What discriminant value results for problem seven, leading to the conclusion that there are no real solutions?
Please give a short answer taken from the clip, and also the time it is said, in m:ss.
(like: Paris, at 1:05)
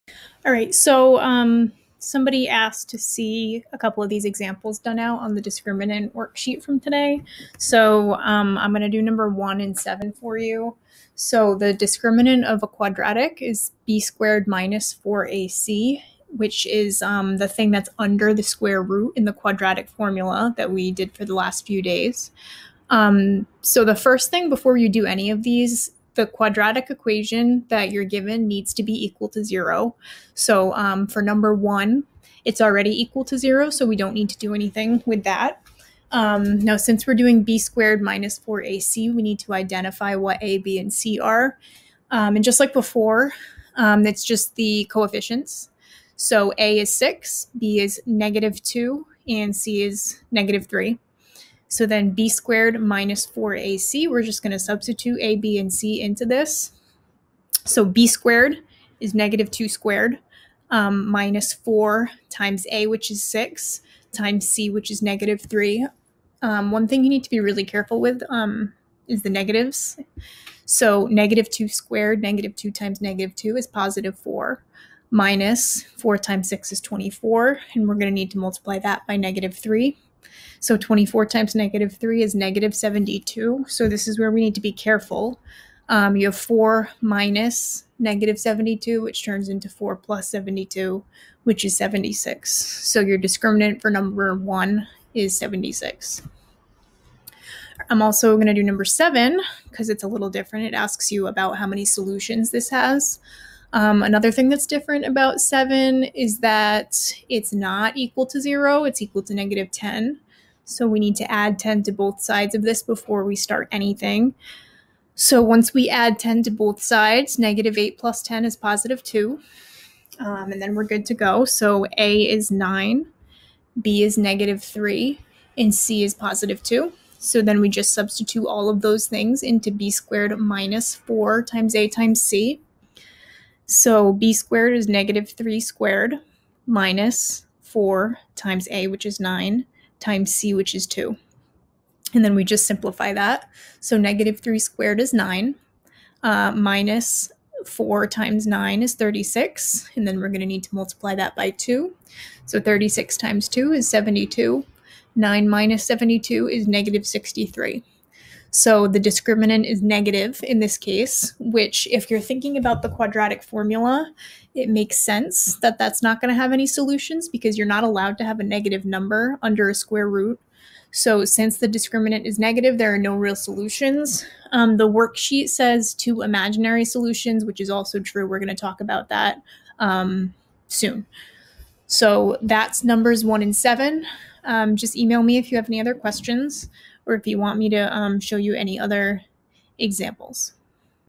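-63, at 2:36.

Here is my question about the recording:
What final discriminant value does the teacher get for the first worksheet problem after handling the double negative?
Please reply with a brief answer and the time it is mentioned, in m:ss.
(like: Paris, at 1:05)
76, at 1:31.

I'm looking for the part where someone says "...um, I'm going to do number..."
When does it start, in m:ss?
0:08.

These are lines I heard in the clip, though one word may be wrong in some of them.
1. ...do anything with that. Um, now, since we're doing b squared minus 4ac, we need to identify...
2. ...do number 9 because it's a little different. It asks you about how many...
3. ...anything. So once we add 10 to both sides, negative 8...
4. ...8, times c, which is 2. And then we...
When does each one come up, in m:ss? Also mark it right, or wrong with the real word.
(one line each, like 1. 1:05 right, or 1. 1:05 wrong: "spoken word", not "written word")
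1. 0:34 right
2. 1:38 wrong: "7", not "9"
3. 1:53 right
4. 2:19 wrong: "9", not "8".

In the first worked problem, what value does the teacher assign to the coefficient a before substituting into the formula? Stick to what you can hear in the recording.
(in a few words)
6.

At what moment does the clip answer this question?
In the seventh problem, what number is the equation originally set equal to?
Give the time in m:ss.
1:49.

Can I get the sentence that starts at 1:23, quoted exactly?
So this is where we need to be careful.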